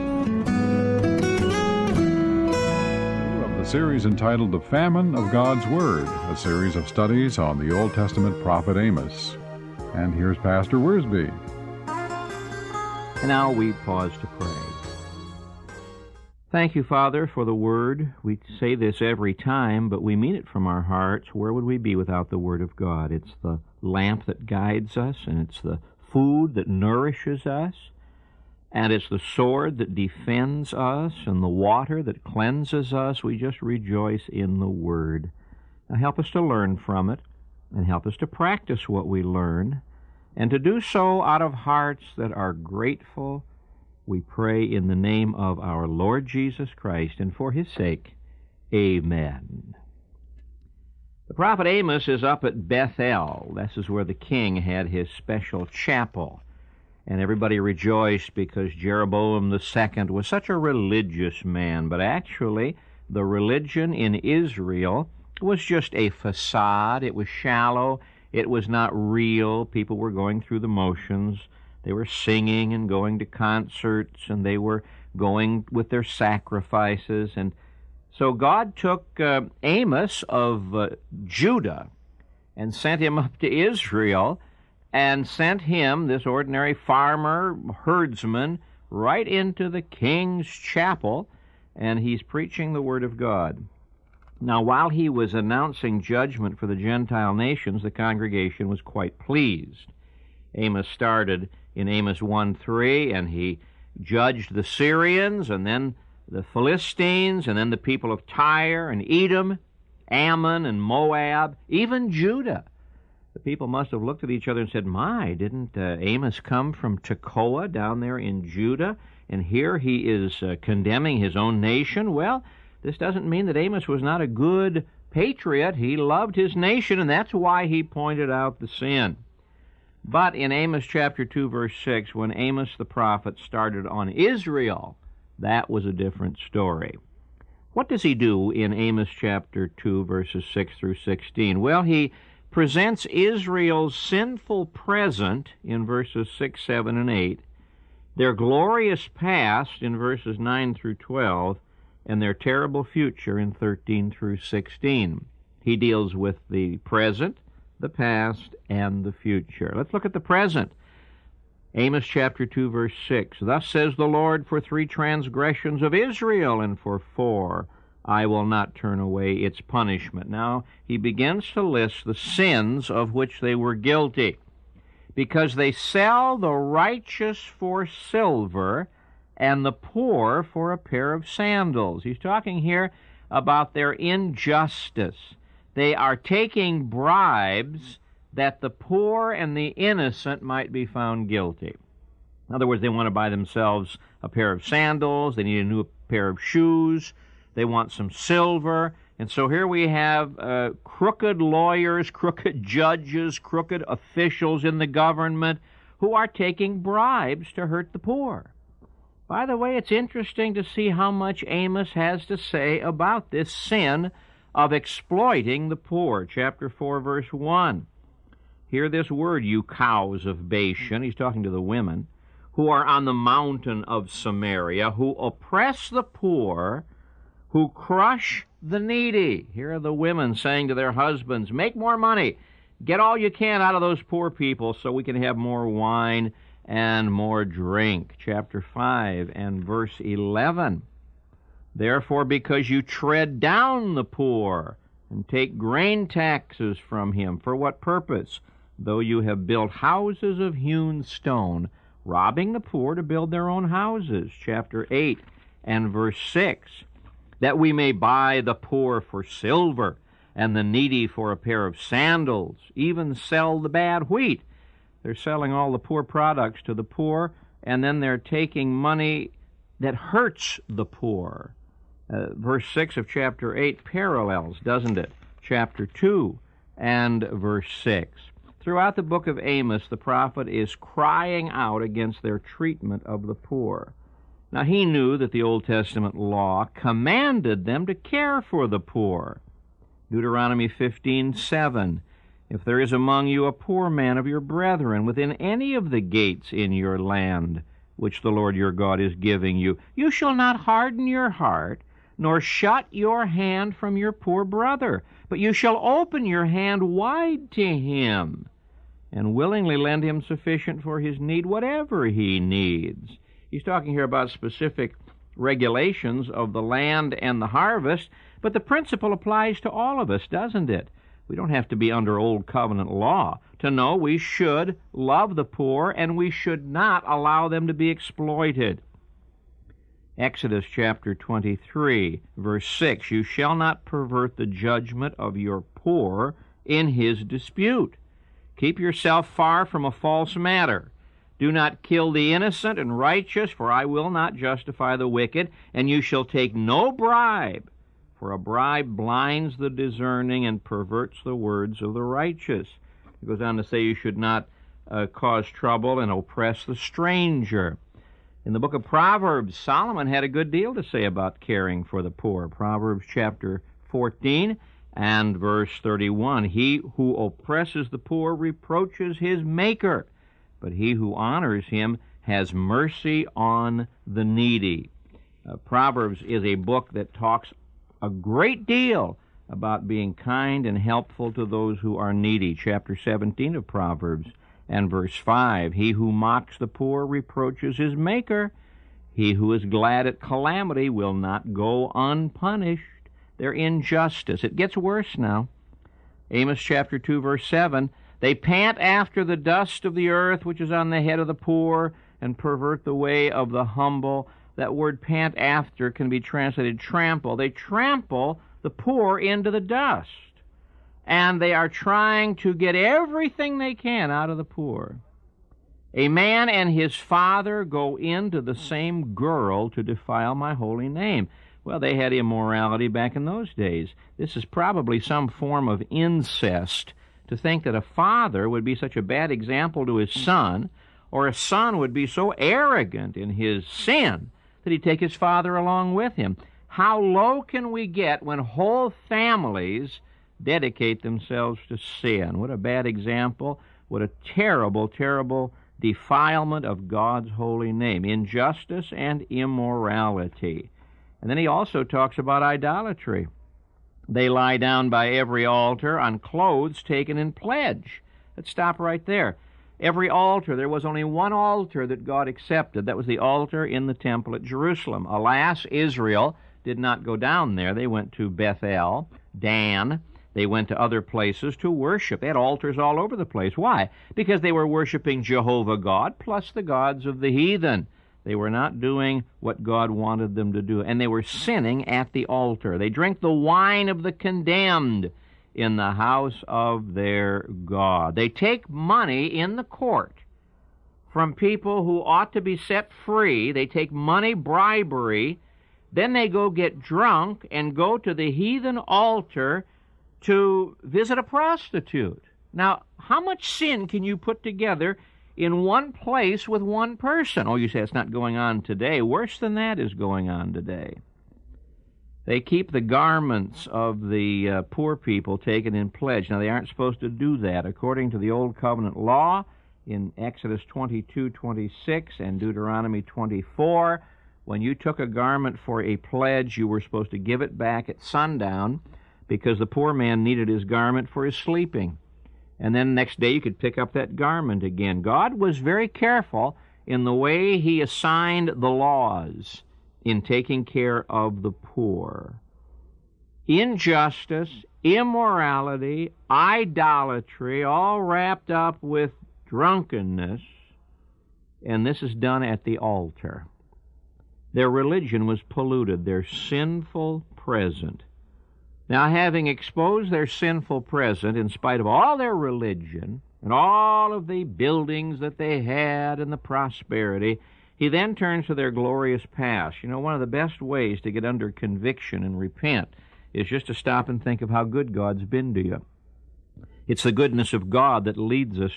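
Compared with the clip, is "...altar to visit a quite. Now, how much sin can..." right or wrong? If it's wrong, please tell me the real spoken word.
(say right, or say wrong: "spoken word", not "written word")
wrong: "prostitute", not "quite".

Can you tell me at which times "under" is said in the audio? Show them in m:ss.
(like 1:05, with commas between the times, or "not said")
5:21, 9:31.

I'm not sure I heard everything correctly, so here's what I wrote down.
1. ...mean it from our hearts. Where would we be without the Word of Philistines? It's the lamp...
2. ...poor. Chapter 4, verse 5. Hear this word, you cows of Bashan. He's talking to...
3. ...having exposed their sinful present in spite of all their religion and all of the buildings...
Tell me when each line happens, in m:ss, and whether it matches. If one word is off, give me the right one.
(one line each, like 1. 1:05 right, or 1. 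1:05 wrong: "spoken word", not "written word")
1. 0:20 wrong: "God", not "Philistines"
2. 3:35 wrong: "1", not "5"
3. 9:19 right.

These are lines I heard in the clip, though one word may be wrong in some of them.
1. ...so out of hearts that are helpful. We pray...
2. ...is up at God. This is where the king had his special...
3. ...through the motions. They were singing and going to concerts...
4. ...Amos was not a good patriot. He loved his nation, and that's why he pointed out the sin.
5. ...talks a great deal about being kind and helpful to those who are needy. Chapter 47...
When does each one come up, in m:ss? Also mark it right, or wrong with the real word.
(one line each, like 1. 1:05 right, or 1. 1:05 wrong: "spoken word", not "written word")
1. 0:40 wrong: "grateful", not "helpful"
2. 0:52 wrong: "Bethel", not "God"
3. 1:10 right
4. 2:03 right
5. 6:17 wrong: "17", not "47".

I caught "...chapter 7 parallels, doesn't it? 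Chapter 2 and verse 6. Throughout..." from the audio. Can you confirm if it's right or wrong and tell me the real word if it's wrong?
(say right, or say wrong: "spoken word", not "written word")
wrong: "8", not "7".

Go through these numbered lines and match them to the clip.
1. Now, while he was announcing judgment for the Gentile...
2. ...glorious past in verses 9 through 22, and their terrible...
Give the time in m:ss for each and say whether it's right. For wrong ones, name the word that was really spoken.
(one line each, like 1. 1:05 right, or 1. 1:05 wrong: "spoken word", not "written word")
1. 1:34 right
2. 2:28 wrong: "12", not "22".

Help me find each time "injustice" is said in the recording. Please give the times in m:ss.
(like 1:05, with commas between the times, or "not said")
3:03, 6:33, 7:28, 9:03.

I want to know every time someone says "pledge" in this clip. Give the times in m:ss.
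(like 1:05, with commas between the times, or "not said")
7:37, 8:35, 8:45.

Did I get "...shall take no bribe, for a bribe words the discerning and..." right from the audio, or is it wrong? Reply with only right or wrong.
wrong.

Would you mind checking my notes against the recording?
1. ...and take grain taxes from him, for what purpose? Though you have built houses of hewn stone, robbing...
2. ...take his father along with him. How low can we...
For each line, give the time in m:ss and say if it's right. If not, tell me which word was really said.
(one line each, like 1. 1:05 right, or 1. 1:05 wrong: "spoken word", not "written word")
1. 4:05 right
2. 7:14 right.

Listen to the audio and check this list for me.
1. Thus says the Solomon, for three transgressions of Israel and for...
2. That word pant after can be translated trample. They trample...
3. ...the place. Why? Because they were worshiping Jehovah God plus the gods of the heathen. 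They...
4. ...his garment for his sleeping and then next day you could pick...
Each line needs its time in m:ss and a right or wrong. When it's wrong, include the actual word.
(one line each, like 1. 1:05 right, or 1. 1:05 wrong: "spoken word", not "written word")
1. 2:43 wrong: "Lord", not "Solomon"
2. 6:44 right
3. 7:53 right
4. 8:50 right.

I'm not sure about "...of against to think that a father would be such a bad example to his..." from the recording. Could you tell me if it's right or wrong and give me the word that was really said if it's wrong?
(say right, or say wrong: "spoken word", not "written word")
wrong: "incest", not "against".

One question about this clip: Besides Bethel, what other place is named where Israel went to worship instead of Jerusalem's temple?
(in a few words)
Dan.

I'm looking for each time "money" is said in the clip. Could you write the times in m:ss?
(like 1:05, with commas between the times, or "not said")
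3:51, 4:28, 8:08, 8:13.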